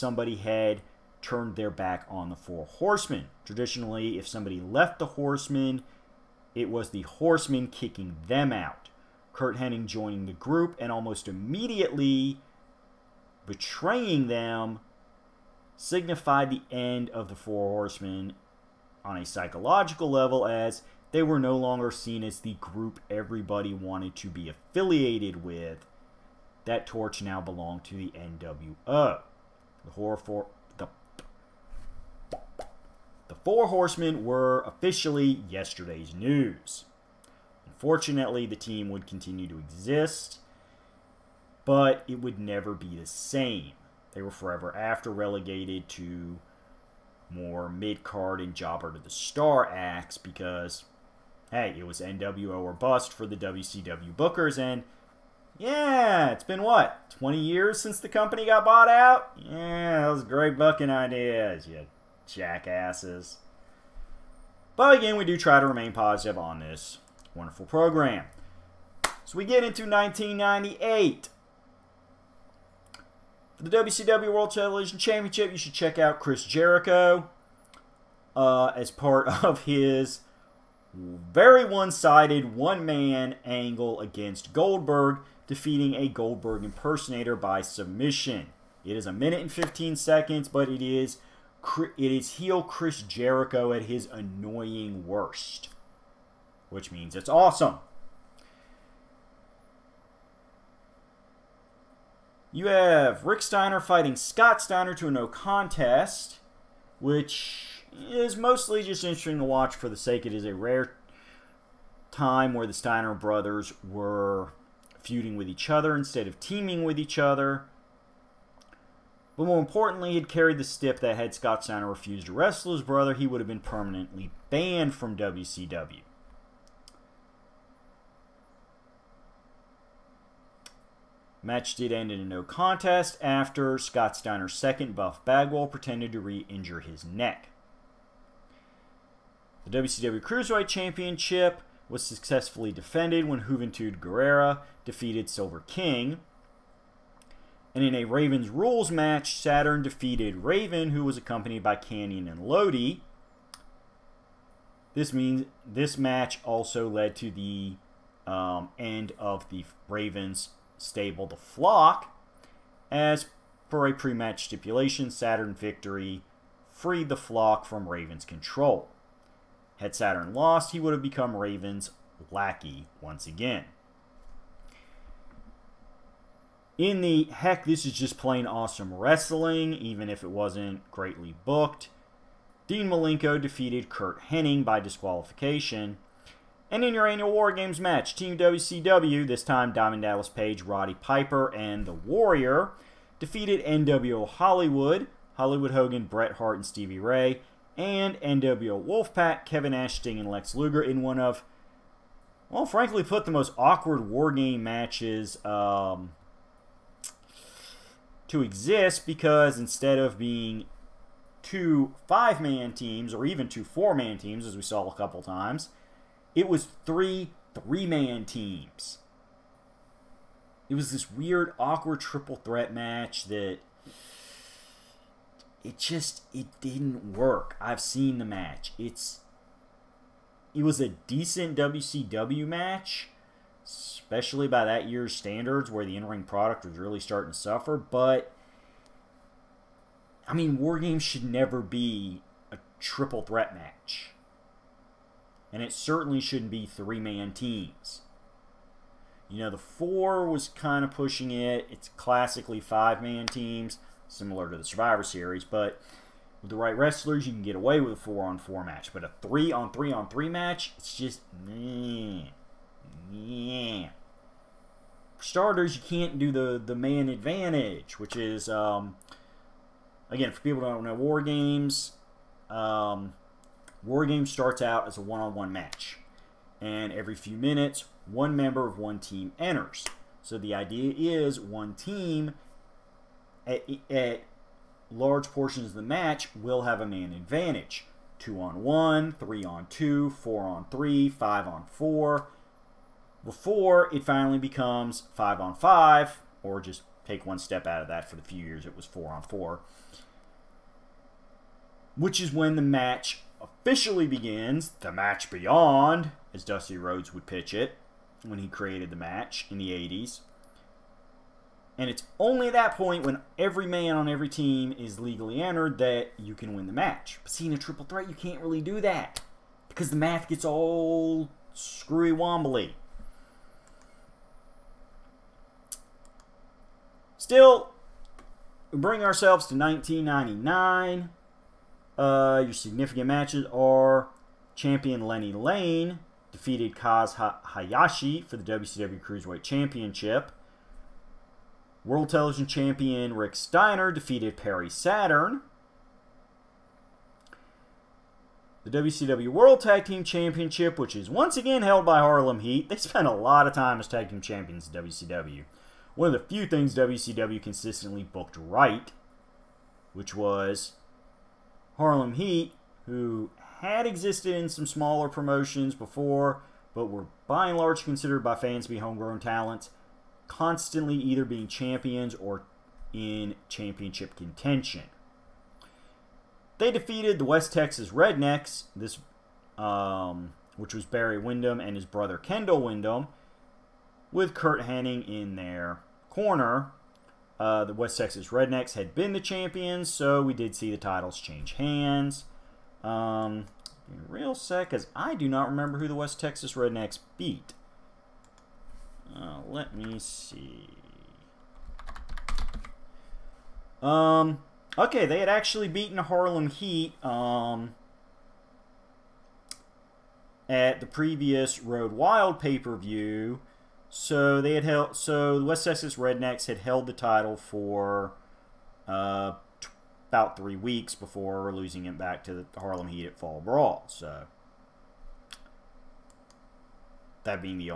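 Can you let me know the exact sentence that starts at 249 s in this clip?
You know, the four was kind of pushing it.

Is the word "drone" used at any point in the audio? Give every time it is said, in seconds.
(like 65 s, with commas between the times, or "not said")
not said.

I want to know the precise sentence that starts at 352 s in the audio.
They spent a lot of time as tag team champions in WCW.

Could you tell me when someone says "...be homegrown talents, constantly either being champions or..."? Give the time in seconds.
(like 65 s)
368 s.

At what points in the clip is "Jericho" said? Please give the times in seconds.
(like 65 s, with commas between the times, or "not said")
76 s, 93 s.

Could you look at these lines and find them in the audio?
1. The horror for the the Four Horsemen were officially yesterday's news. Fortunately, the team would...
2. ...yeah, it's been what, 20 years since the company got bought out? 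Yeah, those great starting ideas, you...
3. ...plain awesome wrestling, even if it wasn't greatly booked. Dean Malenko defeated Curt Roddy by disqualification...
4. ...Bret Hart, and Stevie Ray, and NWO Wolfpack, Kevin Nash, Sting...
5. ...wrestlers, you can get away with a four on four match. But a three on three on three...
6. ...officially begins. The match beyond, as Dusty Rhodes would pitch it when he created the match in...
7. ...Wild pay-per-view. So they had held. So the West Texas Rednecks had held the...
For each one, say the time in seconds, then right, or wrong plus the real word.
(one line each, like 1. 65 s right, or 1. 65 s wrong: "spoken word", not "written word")
1. 29 s right
2. 55 s wrong: "booking", not "starting"
3. 178 s wrong: "Hennig", not "Roddy"
4. 196 s right
5. 256 s right
6. 303 s right
7. 411 s right.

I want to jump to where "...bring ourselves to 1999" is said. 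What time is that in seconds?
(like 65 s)
328 s.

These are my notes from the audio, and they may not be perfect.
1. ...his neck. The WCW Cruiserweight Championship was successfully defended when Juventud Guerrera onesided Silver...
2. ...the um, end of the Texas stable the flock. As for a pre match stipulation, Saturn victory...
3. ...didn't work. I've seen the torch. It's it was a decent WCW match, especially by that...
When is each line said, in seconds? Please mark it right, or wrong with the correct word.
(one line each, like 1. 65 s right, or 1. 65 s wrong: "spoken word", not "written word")
1. 136 s wrong: "defeated", not "onesided"
2. 157 s wrong: "Ravens", not "Texas"
3. 226 s wrong: "match", not "torch".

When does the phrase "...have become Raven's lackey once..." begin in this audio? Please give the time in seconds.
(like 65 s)
170 s.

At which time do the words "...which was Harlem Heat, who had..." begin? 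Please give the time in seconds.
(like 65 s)
359 s.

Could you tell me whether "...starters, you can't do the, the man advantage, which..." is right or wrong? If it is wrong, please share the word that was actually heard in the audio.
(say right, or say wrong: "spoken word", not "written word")
right.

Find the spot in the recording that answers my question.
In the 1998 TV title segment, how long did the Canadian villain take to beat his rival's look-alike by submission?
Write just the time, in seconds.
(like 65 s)
89 s.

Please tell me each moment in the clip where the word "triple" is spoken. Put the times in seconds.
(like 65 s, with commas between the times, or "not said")
222 s, 242 s, 317 s.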